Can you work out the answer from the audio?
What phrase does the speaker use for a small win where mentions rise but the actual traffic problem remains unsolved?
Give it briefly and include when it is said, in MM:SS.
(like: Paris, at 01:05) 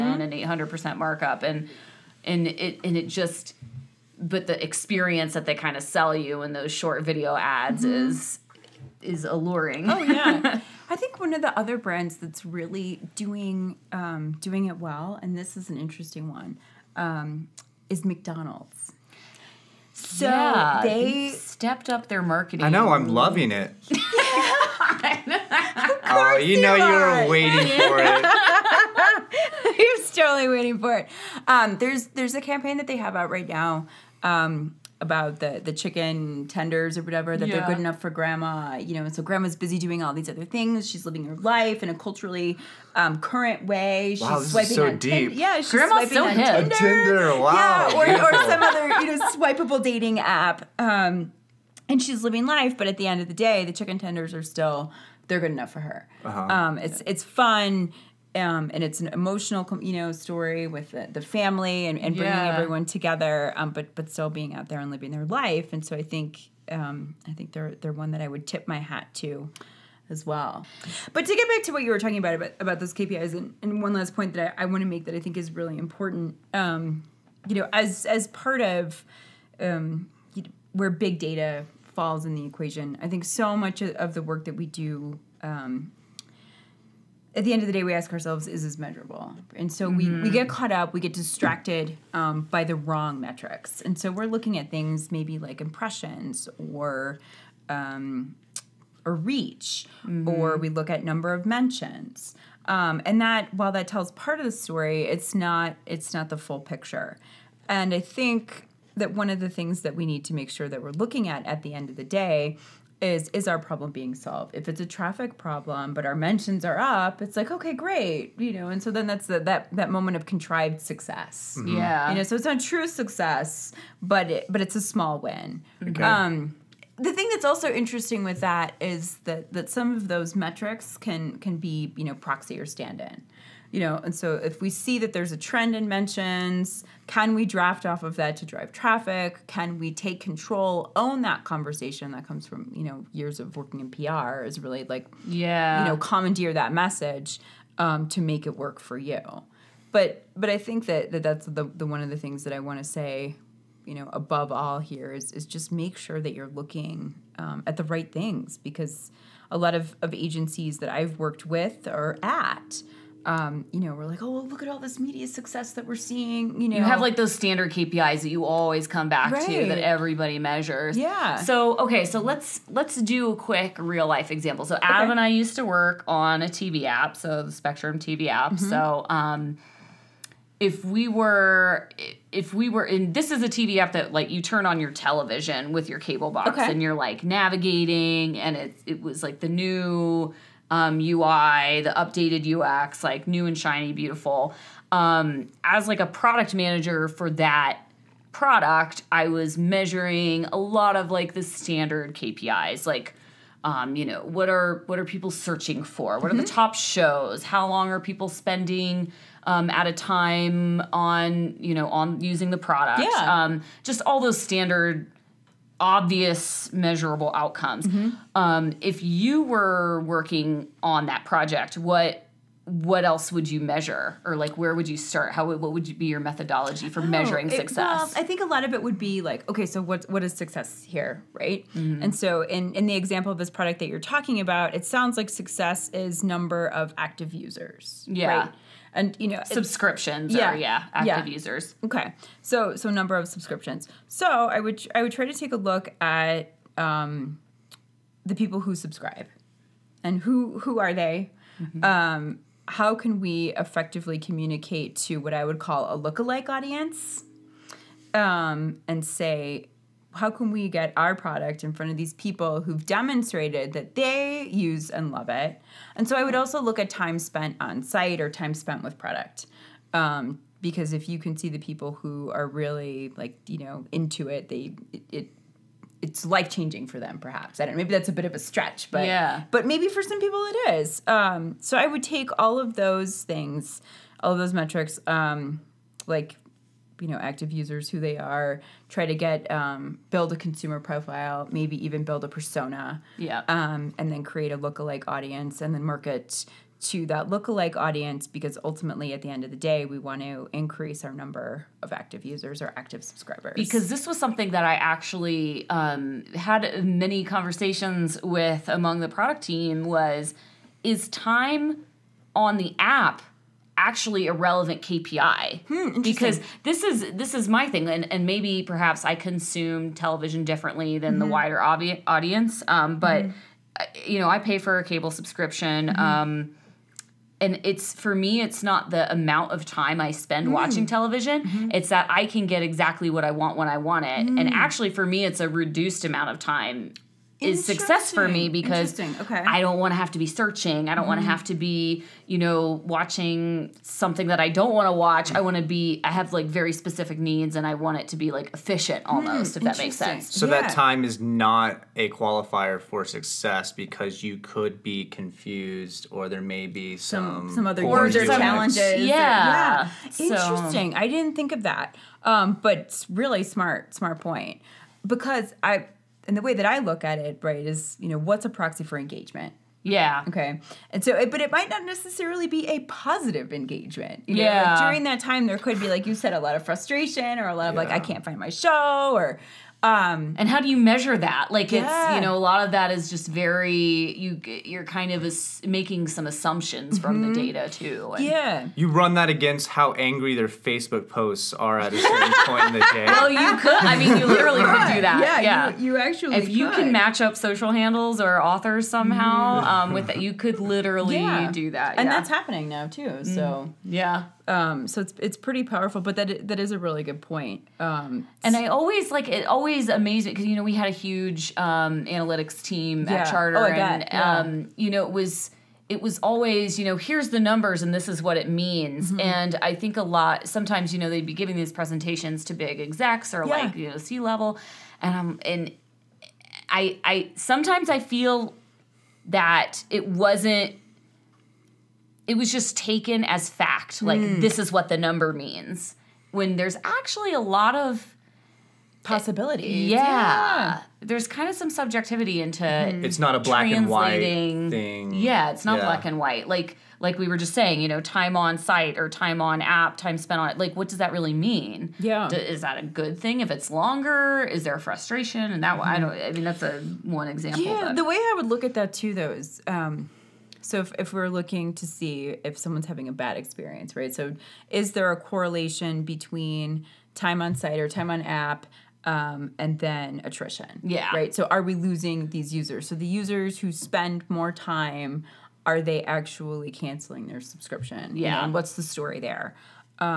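contrived success, at 02:00.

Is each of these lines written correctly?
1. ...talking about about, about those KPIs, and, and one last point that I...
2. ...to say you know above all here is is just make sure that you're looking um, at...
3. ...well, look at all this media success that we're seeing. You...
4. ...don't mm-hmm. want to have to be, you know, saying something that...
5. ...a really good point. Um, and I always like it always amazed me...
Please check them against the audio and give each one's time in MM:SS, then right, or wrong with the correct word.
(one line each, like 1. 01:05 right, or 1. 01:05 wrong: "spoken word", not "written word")
1. 01:11 right
2. 02:32 right
3. 02:44 right
4. 05:40 wrong: "watching", not "saying"
5. 06:46 right.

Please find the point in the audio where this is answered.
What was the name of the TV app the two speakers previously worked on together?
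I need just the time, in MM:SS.
02:57.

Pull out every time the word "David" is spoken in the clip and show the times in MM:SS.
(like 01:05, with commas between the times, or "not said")
not said.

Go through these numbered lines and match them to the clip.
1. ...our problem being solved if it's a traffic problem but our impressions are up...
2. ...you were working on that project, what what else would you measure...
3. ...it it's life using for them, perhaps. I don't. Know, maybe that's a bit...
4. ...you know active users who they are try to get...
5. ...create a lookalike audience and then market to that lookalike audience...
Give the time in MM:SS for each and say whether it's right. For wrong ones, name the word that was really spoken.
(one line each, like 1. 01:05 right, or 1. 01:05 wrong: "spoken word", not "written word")
1. 01:53 wrong: "mentions", not "impressions"
2. 03:39 right
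3. 04:35 wrong: "changing", not "using"
4. 04:47 right
5. 04:54 right.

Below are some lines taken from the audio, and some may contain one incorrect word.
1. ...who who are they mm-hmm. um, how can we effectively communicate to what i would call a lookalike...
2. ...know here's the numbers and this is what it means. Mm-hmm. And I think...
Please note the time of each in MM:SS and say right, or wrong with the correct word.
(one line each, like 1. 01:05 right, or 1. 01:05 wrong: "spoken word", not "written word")
1. 04:10 right
2. 06:56 right.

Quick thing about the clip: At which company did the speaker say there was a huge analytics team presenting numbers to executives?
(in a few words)
Charter.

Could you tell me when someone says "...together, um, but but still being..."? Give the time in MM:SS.
01:02.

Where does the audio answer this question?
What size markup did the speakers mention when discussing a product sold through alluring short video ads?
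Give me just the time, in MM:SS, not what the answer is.
00:00.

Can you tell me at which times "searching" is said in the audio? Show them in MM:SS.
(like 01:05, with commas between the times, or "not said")
03:25, 05:40.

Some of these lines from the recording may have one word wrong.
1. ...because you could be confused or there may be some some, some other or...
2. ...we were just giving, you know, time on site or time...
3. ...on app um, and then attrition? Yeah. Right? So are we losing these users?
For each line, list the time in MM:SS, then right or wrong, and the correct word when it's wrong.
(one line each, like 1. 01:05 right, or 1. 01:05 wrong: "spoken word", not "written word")
1. 05:53 right
2. 07:27 wrong: "saying", not "giving"
3. 07:48 right.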